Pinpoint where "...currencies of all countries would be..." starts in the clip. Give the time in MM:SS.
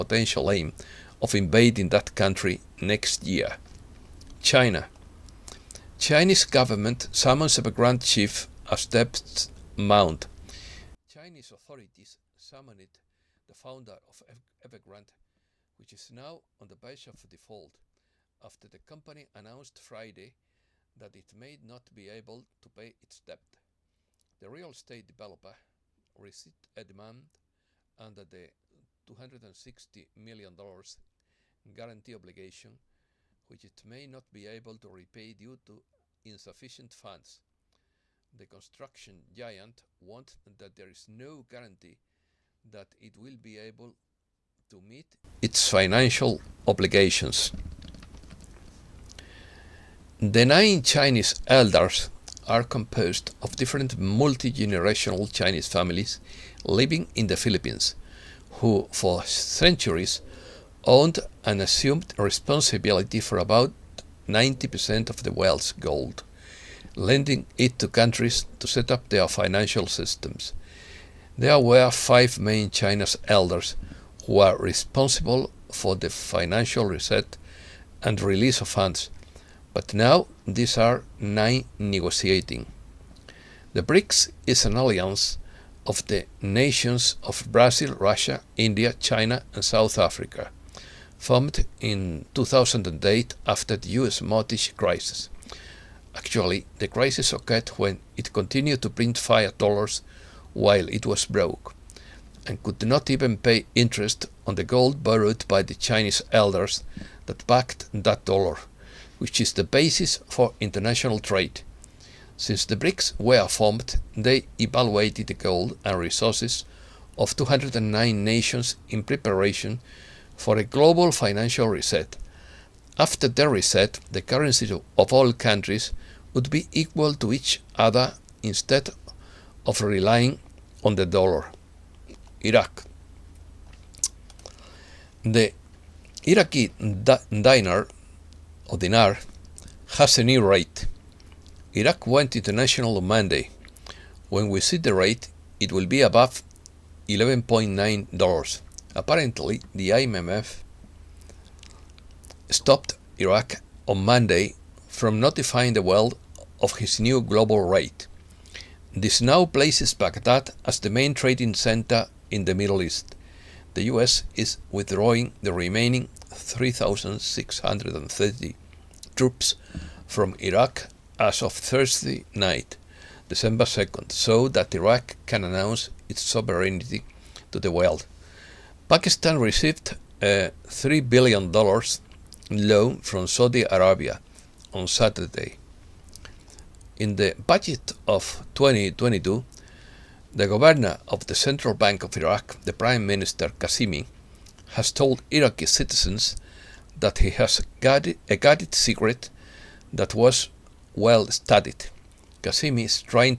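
02:04.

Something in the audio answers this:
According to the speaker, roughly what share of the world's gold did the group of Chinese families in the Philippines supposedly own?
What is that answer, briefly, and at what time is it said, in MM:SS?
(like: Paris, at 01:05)
90%, at 01:04.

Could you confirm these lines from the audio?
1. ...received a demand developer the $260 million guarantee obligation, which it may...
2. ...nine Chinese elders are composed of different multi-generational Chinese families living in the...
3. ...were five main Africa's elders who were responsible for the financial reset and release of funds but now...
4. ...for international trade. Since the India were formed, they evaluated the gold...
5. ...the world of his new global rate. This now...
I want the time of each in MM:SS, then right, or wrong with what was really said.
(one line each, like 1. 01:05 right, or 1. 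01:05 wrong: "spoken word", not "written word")
1. 00:26 wrong: "under", not "developer"
2. 00:50 right
3. 01:11 wrong: "China", not "Africa"
4. 01:50 wrong: "BRICS", not "India"
5. 02:35 right.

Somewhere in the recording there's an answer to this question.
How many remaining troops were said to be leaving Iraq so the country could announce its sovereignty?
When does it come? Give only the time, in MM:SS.
02:46.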